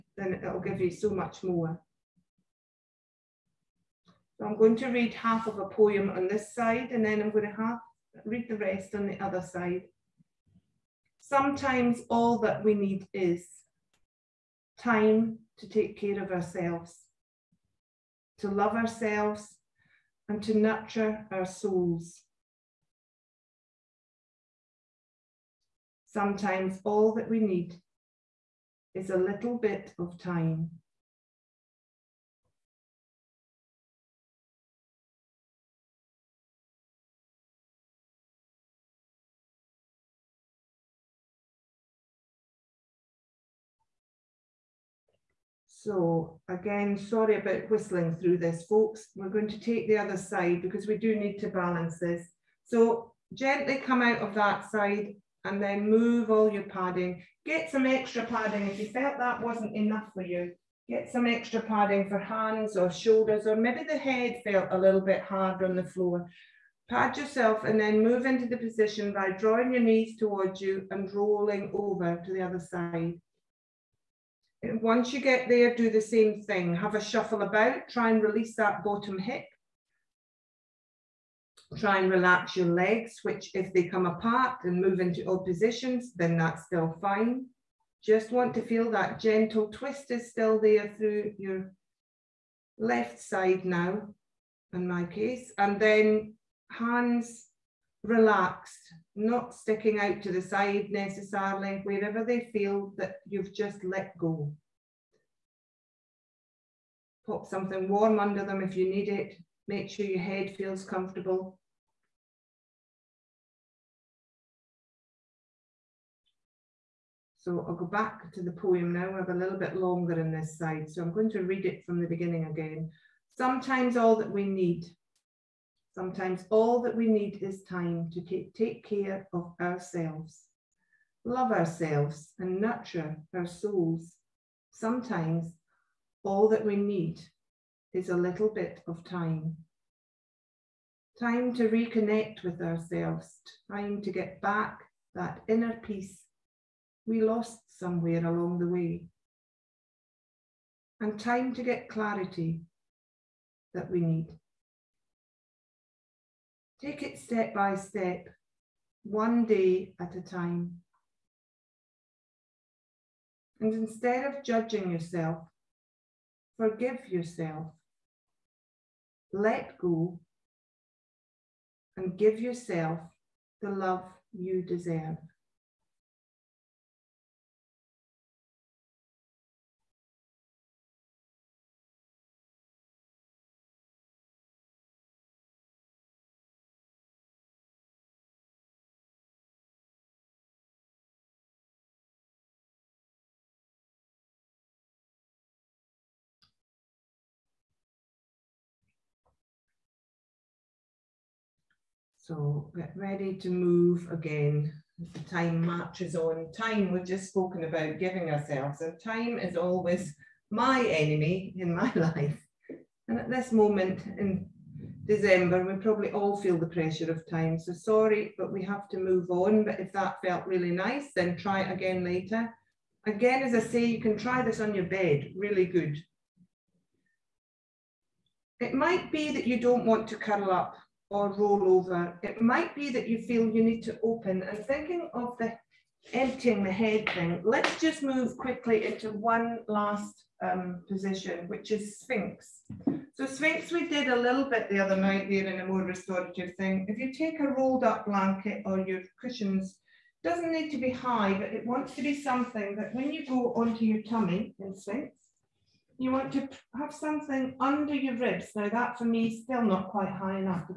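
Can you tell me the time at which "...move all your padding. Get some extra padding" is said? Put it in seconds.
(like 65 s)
55 s.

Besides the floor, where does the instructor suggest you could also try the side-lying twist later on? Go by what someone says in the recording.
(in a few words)
On your bed.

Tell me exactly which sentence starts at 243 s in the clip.
So Sphinx, we did a little bit the other night there in a more restorative thing.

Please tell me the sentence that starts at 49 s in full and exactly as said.
We're going to take the other side because we do need to balance this.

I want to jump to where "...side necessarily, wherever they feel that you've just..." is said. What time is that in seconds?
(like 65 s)
100 s.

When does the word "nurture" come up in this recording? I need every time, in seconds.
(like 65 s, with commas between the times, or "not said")
20 s, 132 s.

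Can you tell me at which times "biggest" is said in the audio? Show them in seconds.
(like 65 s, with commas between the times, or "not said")
not said.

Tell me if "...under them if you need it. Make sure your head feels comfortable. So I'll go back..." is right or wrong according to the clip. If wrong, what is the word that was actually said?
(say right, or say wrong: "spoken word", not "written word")
right.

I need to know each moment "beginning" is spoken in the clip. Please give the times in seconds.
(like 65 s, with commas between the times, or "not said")
122 s.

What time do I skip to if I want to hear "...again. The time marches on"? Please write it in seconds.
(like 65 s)
204 s.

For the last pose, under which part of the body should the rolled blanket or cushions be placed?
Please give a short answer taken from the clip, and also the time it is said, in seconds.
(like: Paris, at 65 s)
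Ribs, at 258 s.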